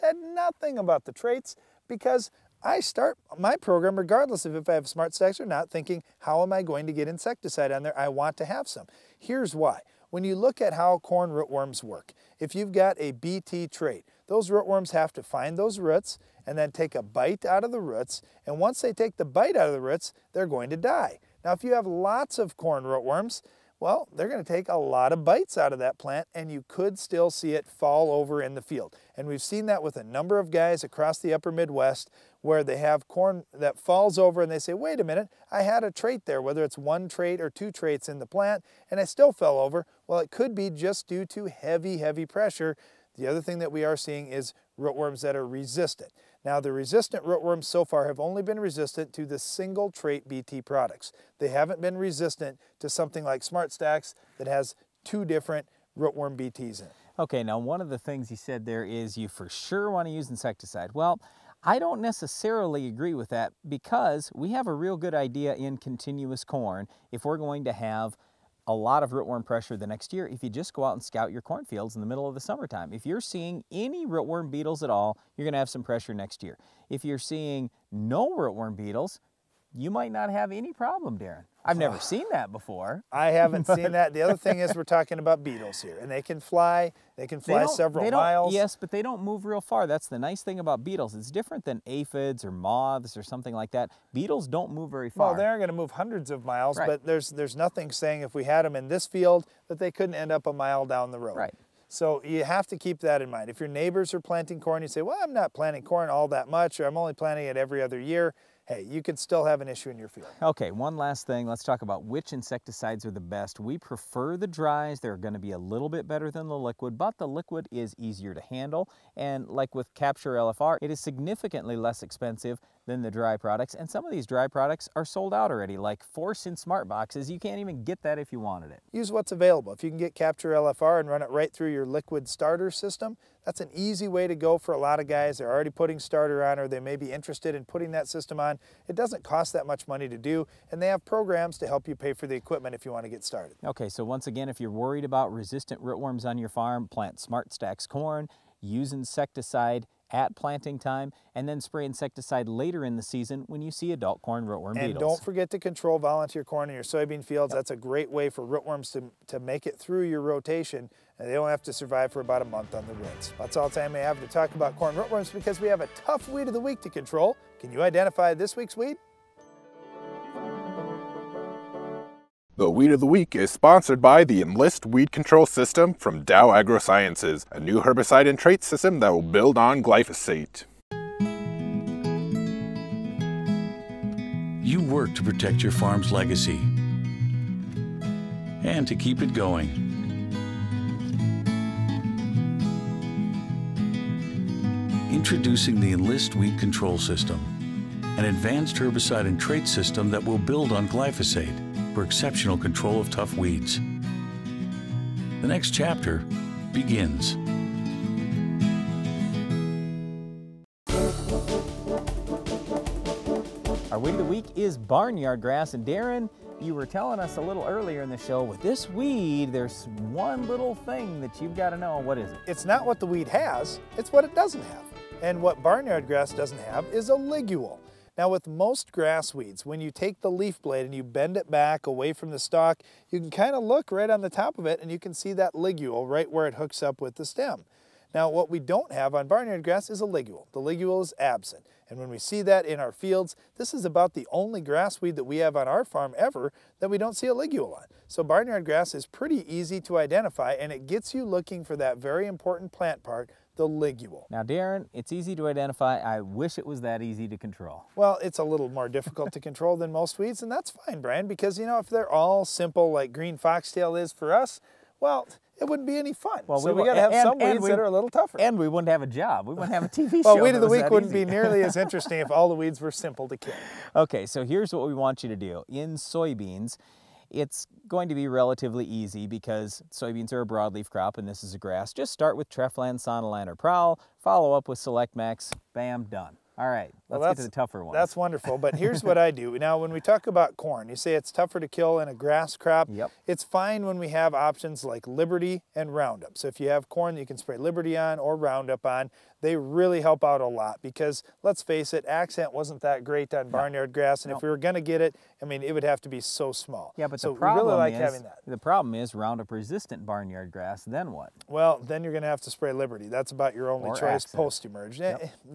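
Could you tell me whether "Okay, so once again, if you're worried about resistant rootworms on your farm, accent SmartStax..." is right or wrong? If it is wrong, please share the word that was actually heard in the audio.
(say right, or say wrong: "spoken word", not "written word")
wrong: "plant", not "accent".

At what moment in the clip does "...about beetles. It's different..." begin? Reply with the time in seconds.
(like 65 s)
90 s.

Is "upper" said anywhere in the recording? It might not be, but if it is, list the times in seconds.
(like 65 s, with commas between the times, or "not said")
31 s.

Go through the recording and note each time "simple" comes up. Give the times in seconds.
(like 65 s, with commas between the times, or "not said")
262 s, 272 s.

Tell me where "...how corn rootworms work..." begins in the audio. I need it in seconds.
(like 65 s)
10 s.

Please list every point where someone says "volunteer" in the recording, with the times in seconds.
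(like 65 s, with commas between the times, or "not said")
155 s.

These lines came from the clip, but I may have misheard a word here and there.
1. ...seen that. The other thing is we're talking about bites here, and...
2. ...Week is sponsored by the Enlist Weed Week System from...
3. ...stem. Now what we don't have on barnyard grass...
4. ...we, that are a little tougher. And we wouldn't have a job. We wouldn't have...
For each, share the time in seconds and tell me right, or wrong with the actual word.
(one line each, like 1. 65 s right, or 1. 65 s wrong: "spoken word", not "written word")
1. 83 s wrong: "beetles", not "bites"
2. 173 s wrong: "Control", not "Week"
3. 237 s right
4. 267 s right.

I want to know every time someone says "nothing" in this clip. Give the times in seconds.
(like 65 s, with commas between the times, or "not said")
0 s, 97 s.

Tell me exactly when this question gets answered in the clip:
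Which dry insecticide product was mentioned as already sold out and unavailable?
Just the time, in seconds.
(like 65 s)
126 s.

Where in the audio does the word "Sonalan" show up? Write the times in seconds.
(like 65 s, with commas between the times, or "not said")
282 s.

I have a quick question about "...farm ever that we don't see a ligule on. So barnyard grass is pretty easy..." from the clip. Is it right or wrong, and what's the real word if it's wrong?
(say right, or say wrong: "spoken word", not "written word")
right.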